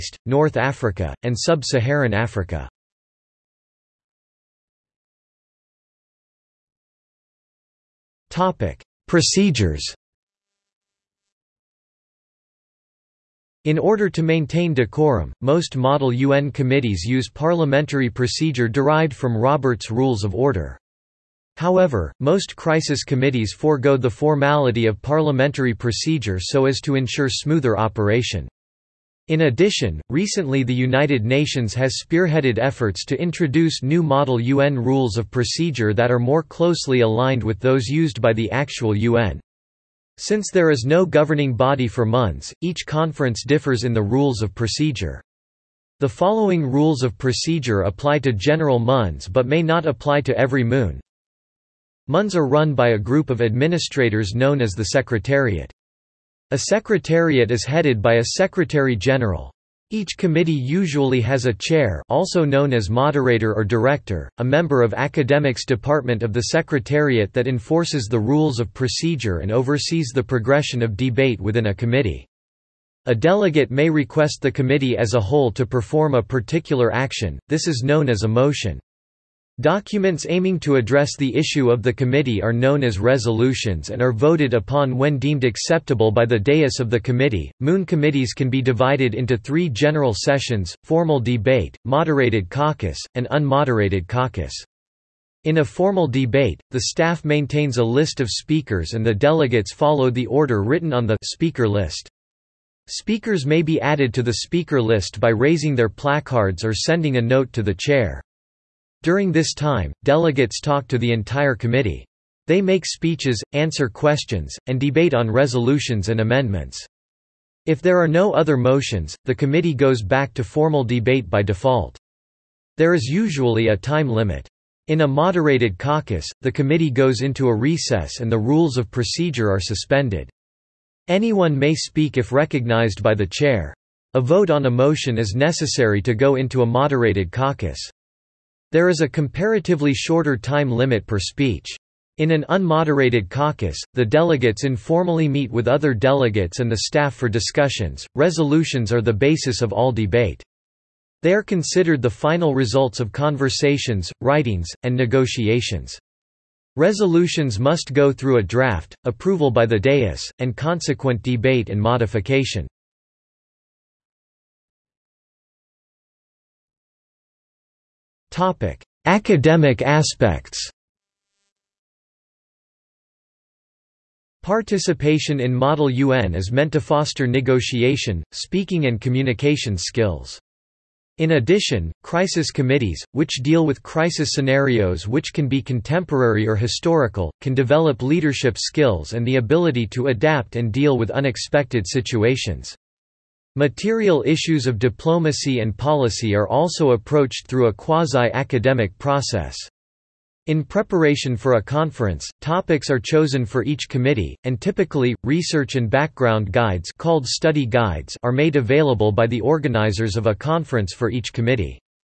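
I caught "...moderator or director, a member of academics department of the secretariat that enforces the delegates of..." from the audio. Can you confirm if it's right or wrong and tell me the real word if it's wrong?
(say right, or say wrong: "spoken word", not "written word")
wrong: "rules", not "delegates".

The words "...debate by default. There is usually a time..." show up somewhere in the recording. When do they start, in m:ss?
2:00.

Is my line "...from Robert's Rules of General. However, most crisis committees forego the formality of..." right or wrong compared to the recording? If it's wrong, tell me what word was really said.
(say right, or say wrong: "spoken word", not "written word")
wrong: "Order", not "General".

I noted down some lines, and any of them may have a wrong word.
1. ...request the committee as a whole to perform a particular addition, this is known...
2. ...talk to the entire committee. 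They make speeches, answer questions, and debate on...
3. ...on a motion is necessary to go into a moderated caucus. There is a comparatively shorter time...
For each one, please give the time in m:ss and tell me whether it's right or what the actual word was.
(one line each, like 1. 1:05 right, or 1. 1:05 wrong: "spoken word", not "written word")
1. 1:13 wrong: "action", not "addition"
2. 1:50 right
3. 2:14 right.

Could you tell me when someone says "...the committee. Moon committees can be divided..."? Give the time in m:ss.
1:26.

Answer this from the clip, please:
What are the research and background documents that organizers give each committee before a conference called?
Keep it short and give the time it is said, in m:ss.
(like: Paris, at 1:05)
study guides, at 3:27.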